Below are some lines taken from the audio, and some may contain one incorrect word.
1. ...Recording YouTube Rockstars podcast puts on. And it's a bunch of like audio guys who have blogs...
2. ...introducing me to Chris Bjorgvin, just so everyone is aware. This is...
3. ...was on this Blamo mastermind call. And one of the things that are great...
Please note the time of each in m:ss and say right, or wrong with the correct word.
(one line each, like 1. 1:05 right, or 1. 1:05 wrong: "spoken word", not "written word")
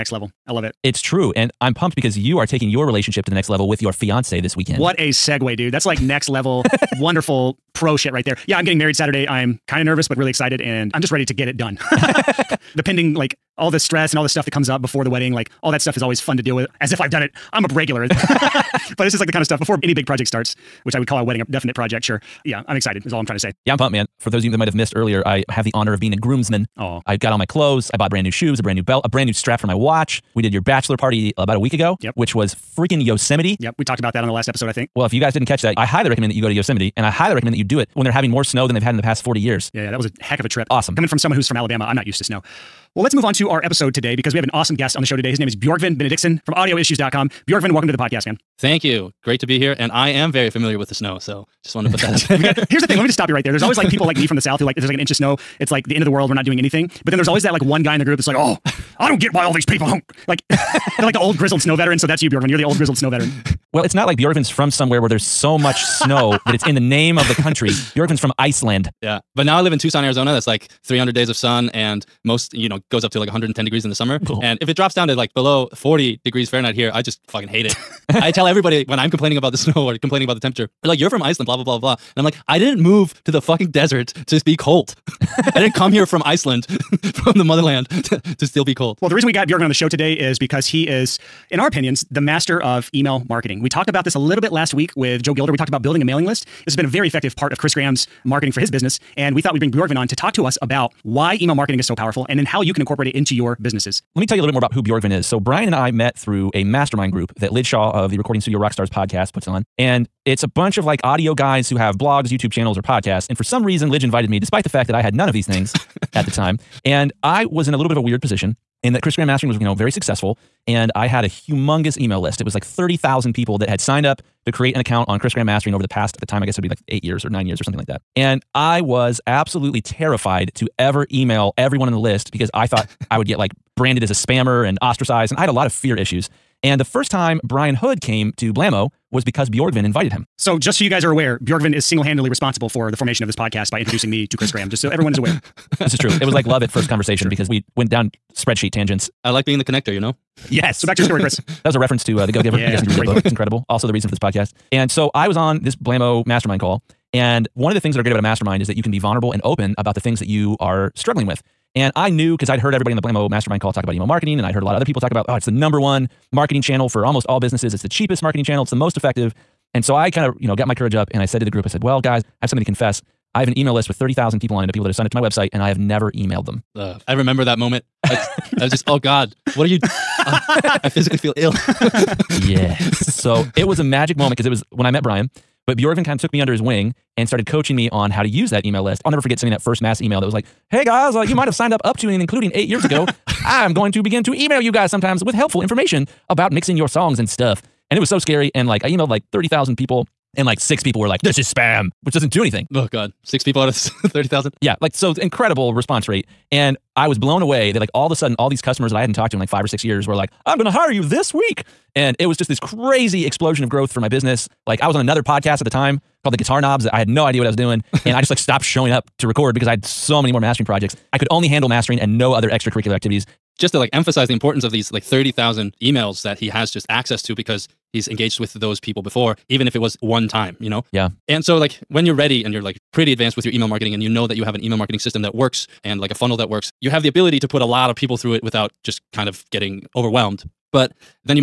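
1. 1:48 wrong: "Studio", not "YouTube"
2. 2:23 wrong: "Graham", not "Bjorgvin"
3. 2:35 right.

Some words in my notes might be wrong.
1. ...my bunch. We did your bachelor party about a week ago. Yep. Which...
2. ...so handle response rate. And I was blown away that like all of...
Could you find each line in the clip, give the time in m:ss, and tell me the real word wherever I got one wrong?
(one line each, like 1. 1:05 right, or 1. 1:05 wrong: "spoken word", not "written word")
1. 0:29 wrong: "watch", not "bunch"
2. 3:24 wrong: "incredible", not "handle".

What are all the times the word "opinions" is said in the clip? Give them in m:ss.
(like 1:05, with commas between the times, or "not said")
1:31.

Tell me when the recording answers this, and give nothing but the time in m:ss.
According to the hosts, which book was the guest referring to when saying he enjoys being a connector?
2:32.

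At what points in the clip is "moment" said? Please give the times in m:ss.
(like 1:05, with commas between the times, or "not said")
2:57, 3:04.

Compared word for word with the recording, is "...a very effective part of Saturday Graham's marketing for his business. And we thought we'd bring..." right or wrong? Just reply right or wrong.
wrong.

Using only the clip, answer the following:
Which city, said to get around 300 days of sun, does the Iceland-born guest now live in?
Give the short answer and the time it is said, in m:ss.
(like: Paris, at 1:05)
Tucson, Arizona, at 1:09.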